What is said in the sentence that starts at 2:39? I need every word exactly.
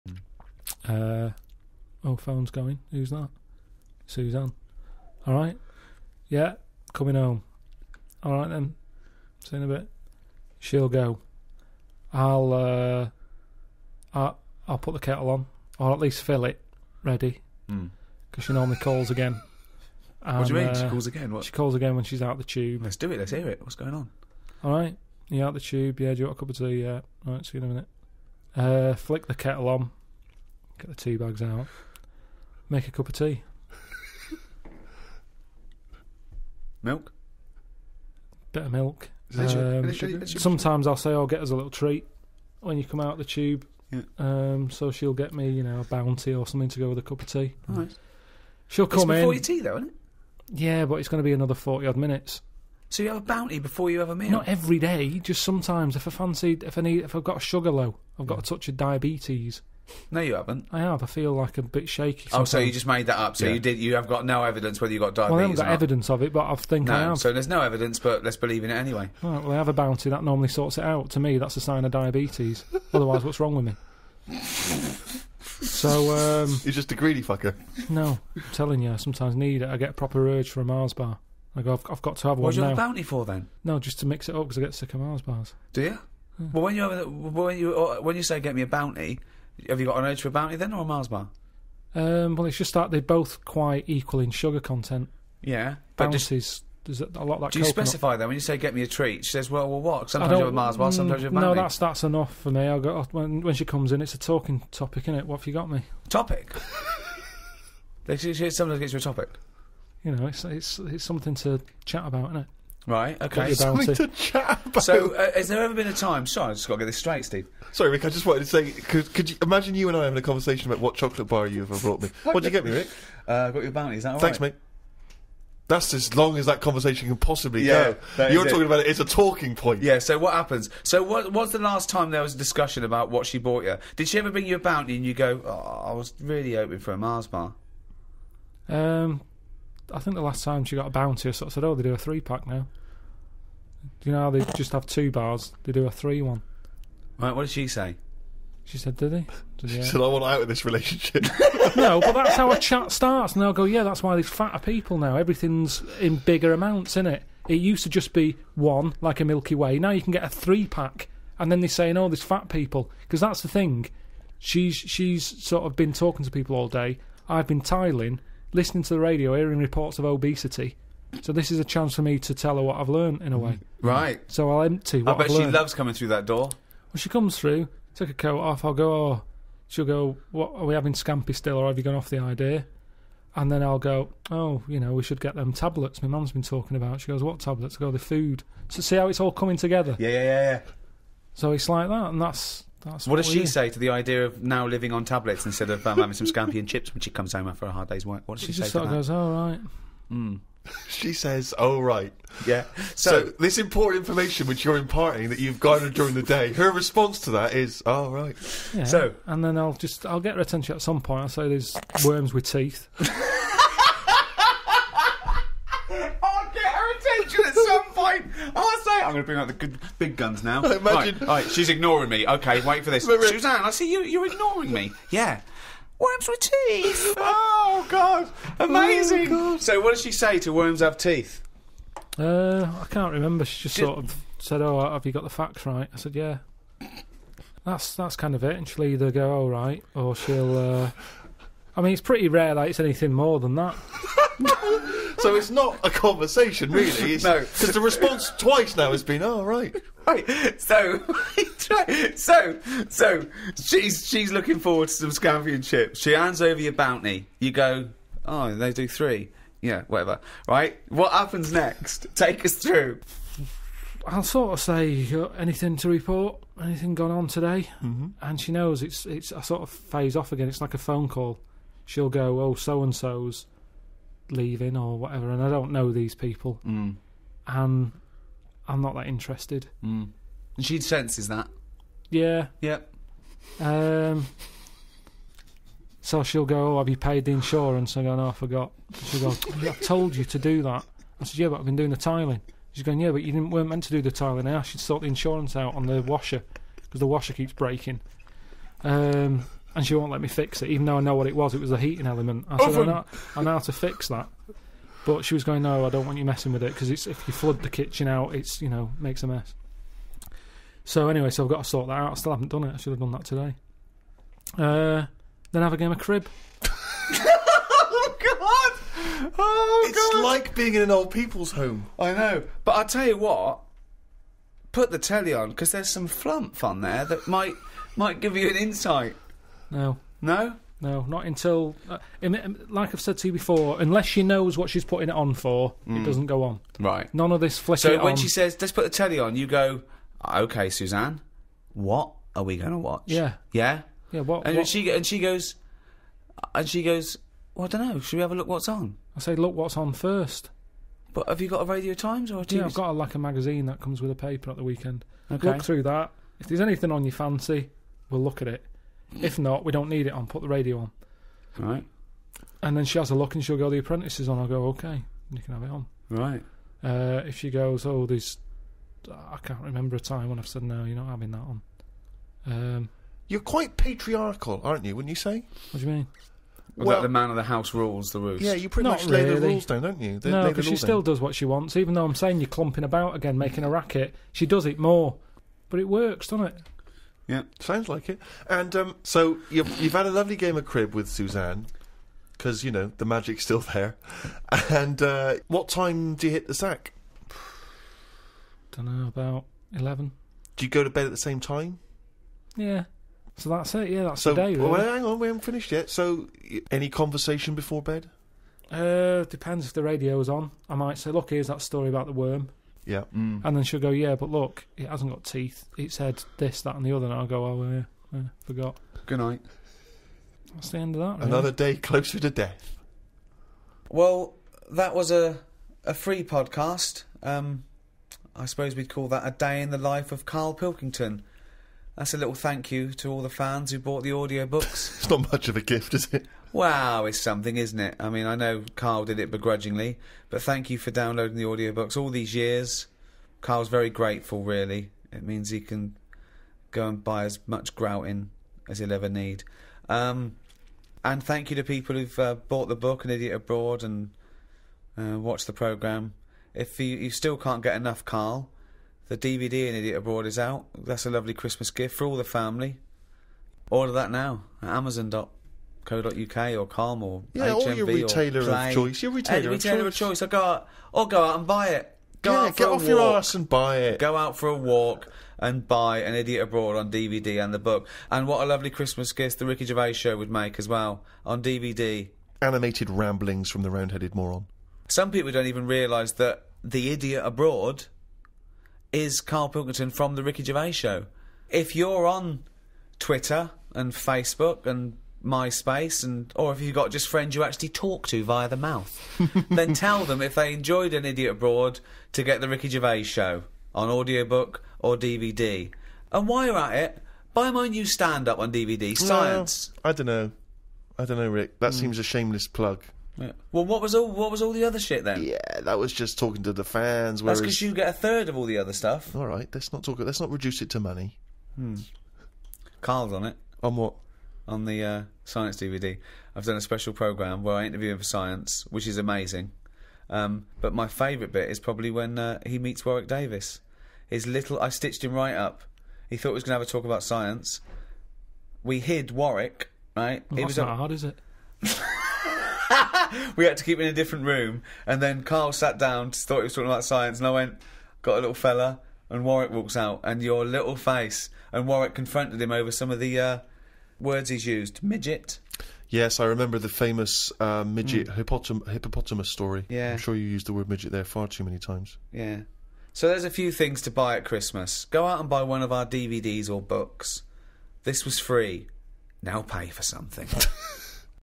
Now you can get a three pack." And then they're saying, "Oh, there's fat people," because that's the thing.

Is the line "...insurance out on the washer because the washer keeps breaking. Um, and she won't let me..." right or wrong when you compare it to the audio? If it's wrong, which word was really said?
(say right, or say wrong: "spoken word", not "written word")
right.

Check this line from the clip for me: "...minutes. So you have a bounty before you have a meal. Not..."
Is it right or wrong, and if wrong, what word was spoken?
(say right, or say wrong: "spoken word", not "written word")
right.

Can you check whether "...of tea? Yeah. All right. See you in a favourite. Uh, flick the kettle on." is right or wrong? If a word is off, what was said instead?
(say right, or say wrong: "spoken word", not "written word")
wrong: "minute", not "favourite".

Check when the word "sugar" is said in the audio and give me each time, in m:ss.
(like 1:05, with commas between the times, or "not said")
0:57, 1:34.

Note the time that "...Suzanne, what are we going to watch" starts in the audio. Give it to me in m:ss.
5:40.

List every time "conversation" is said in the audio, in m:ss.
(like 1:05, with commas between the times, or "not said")
2:00, 2:06, 4:05, 6:46.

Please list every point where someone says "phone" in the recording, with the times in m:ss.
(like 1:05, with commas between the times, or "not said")
0:02, 4:30.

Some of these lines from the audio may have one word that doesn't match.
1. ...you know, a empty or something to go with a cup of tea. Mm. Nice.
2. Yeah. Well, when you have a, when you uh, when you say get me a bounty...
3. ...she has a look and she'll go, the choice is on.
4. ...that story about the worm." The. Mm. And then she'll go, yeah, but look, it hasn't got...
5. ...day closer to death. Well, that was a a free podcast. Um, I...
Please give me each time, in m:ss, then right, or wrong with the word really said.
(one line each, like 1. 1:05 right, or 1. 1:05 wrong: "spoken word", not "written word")
1. 0:45 wrong: "bounty", not "empty"
2. 1:26 right
3. 6:02 wrong: "apprentice", not "choice"
4. 6:51 wrong: "Yeah", not "The"
5. 7:01 right.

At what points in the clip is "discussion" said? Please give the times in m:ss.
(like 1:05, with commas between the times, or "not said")
2:12.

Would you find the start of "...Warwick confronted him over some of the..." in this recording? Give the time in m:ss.
9:11.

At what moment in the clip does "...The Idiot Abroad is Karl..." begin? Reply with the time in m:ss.
8:06.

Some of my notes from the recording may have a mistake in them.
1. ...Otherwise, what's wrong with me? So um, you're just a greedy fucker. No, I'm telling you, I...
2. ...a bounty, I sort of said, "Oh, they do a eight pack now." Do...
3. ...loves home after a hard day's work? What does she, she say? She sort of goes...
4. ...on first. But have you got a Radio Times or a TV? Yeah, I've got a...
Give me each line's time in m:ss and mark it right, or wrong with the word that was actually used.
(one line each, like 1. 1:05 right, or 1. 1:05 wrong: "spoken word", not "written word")
1. 1:12 right
2. 2:20 wrong: "three", not "eight"
3. 3:17 wrong: "comes", not "loves"
4. 5:49 right.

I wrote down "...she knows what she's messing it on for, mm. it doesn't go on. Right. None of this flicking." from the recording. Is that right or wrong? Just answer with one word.
wrong.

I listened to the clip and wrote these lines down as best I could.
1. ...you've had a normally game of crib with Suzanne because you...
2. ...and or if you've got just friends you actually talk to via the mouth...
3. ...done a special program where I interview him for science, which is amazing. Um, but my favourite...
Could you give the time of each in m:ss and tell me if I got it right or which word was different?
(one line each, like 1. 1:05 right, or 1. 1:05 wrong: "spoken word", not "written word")
1. 6:29 wrong: "lovely", not "normally"
2. 8:16 right
3. 8:46 right.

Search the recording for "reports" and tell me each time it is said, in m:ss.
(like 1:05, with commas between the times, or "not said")
2:49, 4:25.